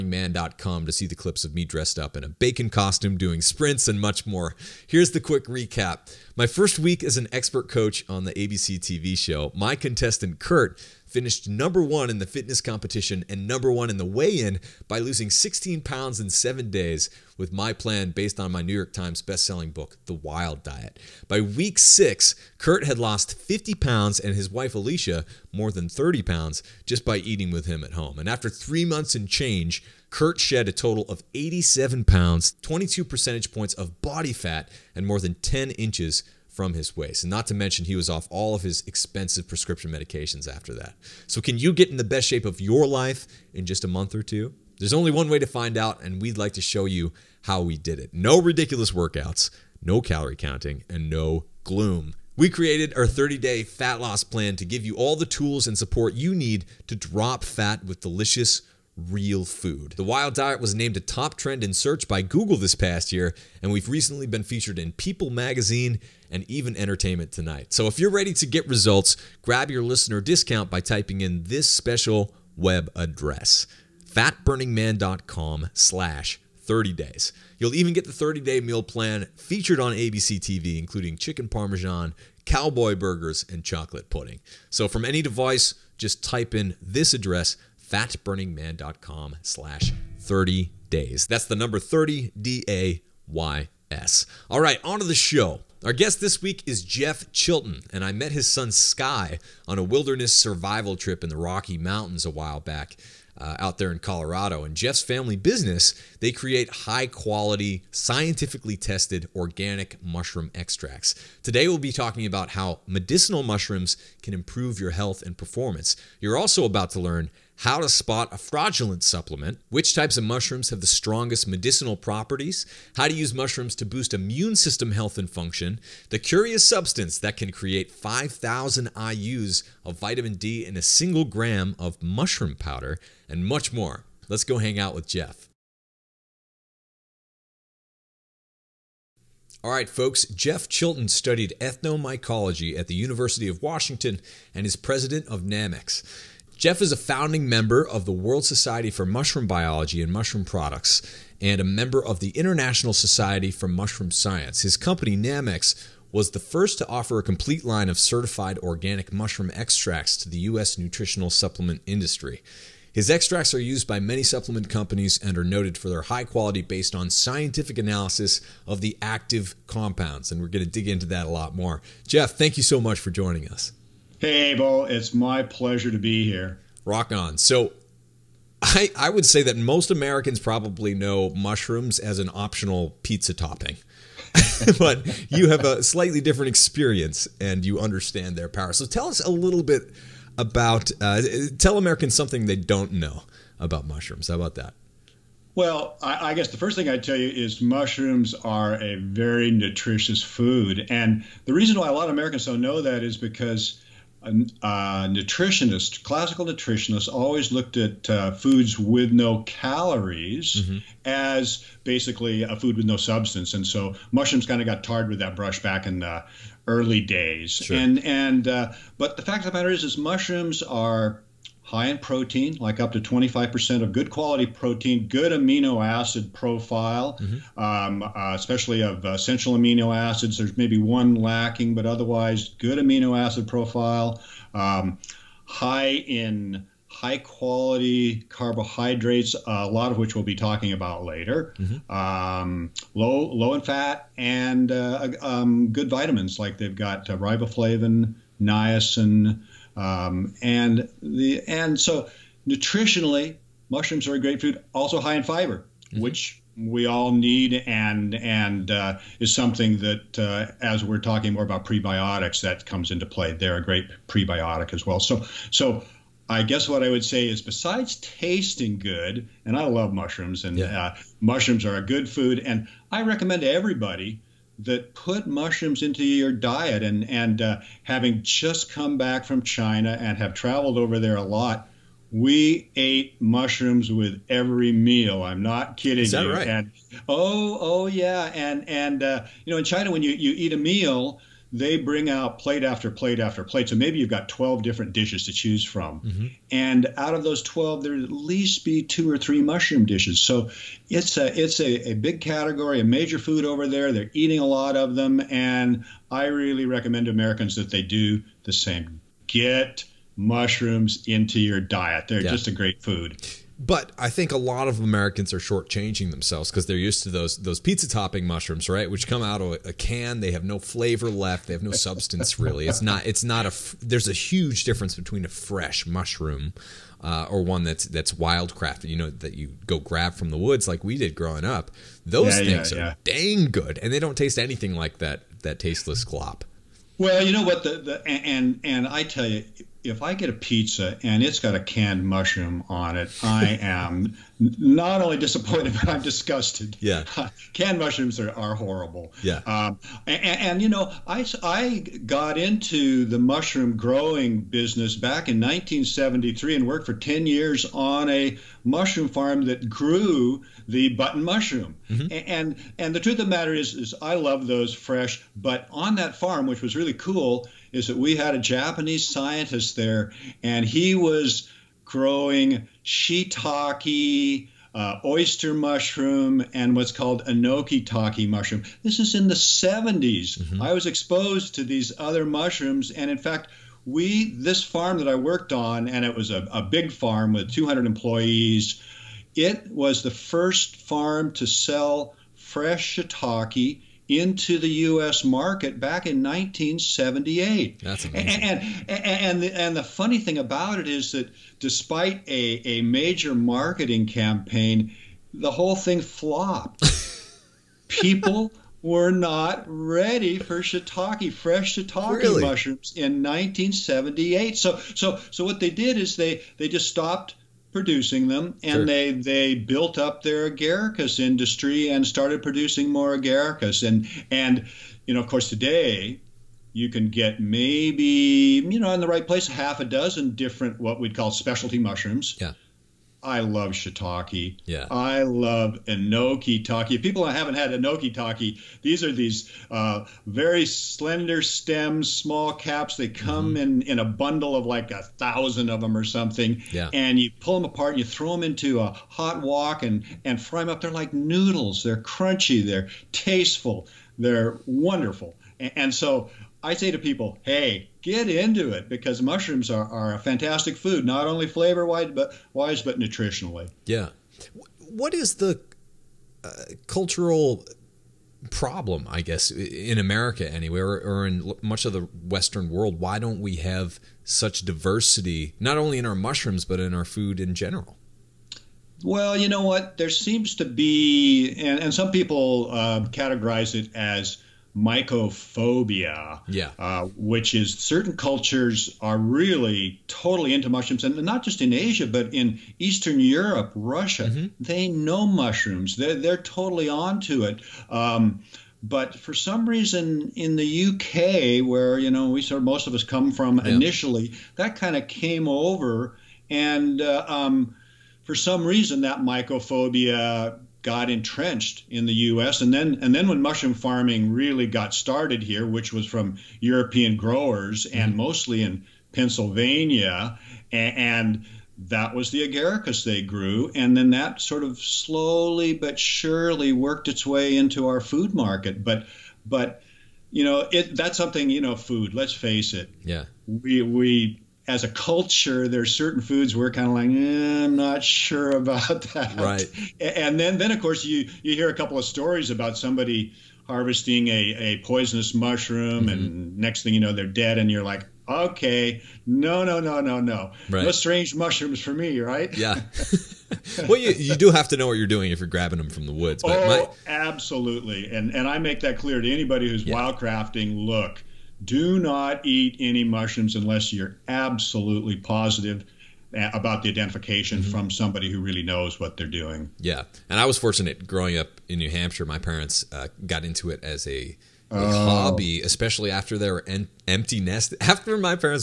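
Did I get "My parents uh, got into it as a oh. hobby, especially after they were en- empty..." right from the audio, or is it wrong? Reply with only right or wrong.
right.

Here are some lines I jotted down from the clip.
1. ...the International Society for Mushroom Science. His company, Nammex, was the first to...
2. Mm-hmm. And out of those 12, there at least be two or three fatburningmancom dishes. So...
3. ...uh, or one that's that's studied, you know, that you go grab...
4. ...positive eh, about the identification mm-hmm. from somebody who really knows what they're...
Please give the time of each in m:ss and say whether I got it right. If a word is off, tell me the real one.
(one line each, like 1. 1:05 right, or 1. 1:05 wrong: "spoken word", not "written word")
1. 2:32 right
2. 4:55 wrong: "mushroom", not "fatburningmancom"
3. 5:27 wrong: "wildcrafted", not "studied"
4. 9:25 right.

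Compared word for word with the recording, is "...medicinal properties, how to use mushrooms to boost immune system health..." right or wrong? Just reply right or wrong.
right.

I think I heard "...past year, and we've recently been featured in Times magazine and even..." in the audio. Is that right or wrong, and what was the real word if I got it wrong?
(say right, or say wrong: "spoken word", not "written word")
wrong: "People", not "Times".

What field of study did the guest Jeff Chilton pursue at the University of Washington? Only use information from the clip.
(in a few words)
Ethnomycology.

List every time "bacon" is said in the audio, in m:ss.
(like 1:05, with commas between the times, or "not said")
0:02.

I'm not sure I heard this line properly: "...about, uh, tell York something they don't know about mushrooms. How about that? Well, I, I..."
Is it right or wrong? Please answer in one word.
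wrong.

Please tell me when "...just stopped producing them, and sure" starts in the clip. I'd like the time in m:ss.
6:56.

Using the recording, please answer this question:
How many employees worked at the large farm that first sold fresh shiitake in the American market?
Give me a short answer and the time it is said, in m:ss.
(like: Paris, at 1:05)
200, at 6:27.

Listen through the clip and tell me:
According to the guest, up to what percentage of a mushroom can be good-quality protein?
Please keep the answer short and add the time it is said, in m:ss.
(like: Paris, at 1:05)
25%, at 3:42.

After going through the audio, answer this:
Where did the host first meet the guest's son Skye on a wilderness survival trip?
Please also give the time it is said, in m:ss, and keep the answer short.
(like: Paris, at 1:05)
Rocky Mountains, at 1:41.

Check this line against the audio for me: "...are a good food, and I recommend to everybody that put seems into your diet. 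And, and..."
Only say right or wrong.
wrong.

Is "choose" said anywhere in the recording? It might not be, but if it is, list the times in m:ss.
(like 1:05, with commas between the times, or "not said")
4:55.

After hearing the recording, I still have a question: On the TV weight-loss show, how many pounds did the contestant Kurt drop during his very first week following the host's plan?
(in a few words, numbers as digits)
16.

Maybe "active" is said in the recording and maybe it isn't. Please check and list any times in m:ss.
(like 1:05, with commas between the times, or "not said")
2:49.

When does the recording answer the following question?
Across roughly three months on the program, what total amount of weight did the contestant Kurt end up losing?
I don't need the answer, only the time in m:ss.
0:31.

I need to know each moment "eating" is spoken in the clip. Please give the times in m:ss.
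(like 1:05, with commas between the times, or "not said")
0:27, 5:04.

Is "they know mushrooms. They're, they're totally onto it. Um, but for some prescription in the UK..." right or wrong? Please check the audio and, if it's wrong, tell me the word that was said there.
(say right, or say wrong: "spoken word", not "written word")
wrong: "reason", not "prescription".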